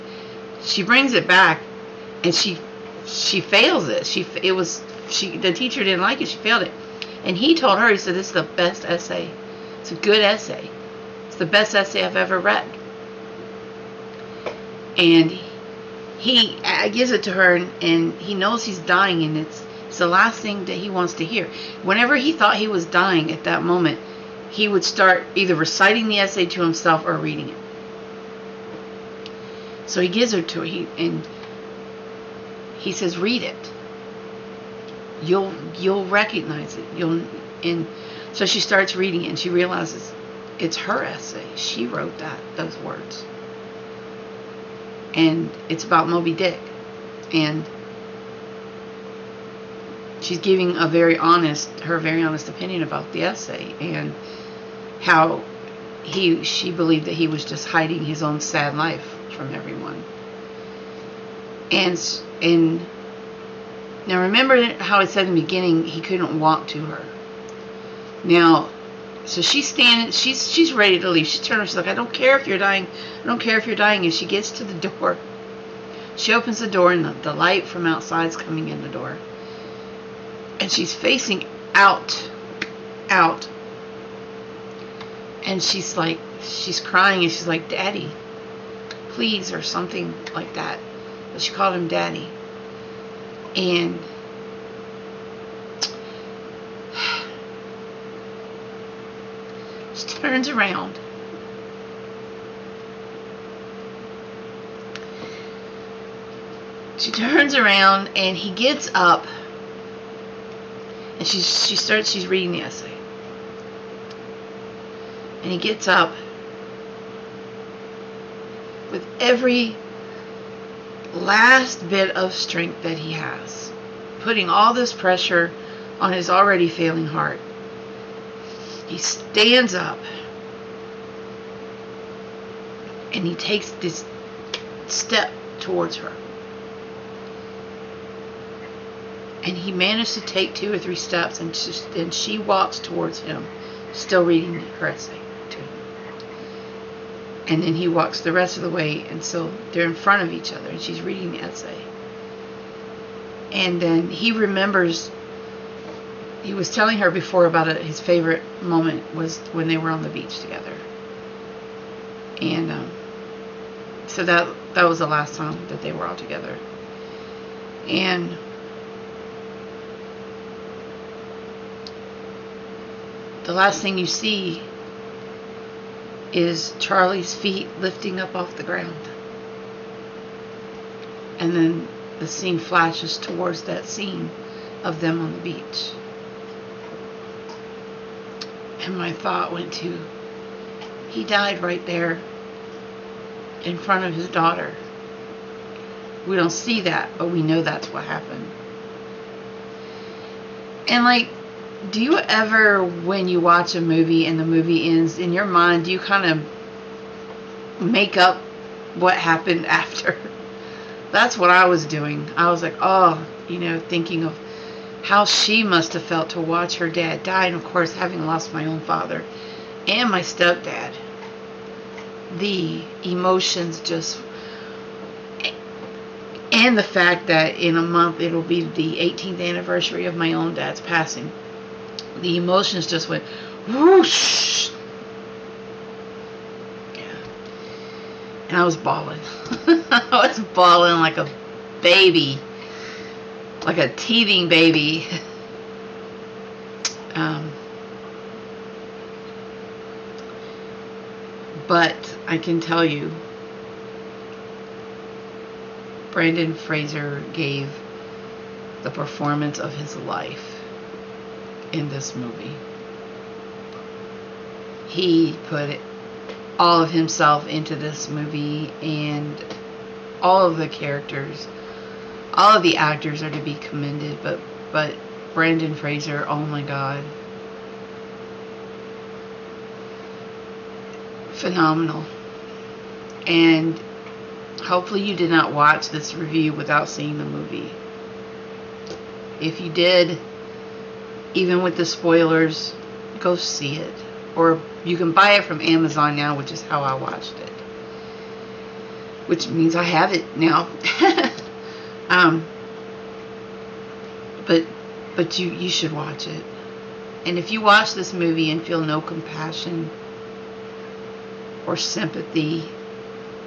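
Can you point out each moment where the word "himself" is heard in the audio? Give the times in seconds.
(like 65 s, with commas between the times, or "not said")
26 s, 266 s.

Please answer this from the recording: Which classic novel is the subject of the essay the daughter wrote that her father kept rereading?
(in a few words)
Moby Dick.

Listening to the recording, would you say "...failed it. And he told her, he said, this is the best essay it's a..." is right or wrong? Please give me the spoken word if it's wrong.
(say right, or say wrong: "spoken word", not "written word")
right.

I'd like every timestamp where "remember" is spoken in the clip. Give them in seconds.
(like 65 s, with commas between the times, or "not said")
64 s, 154 s.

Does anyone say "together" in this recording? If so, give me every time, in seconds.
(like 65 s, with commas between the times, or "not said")
160 s, 166 s.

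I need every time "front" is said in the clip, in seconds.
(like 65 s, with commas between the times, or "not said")
149 s, 193 s.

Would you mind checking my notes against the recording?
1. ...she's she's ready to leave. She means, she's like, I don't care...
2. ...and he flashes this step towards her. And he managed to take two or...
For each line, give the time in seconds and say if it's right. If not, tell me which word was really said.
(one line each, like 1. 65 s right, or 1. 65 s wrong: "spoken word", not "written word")
1. 70 s wrong: "turns", not "means"
2. 133 s wrong: "takes", not "flashes".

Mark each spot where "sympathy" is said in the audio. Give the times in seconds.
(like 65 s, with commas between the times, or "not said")
311 s.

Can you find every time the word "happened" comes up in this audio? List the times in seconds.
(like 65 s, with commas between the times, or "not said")
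198 s, 209 s.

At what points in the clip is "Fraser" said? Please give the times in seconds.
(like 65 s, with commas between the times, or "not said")
256 s, 275 s.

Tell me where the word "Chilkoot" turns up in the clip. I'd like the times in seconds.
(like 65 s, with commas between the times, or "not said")
not said.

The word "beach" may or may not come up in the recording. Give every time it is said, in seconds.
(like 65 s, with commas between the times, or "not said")
160 s, 185 s.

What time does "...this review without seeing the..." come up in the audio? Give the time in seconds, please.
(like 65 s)
285 s.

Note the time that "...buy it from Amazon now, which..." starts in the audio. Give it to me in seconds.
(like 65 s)
295 s.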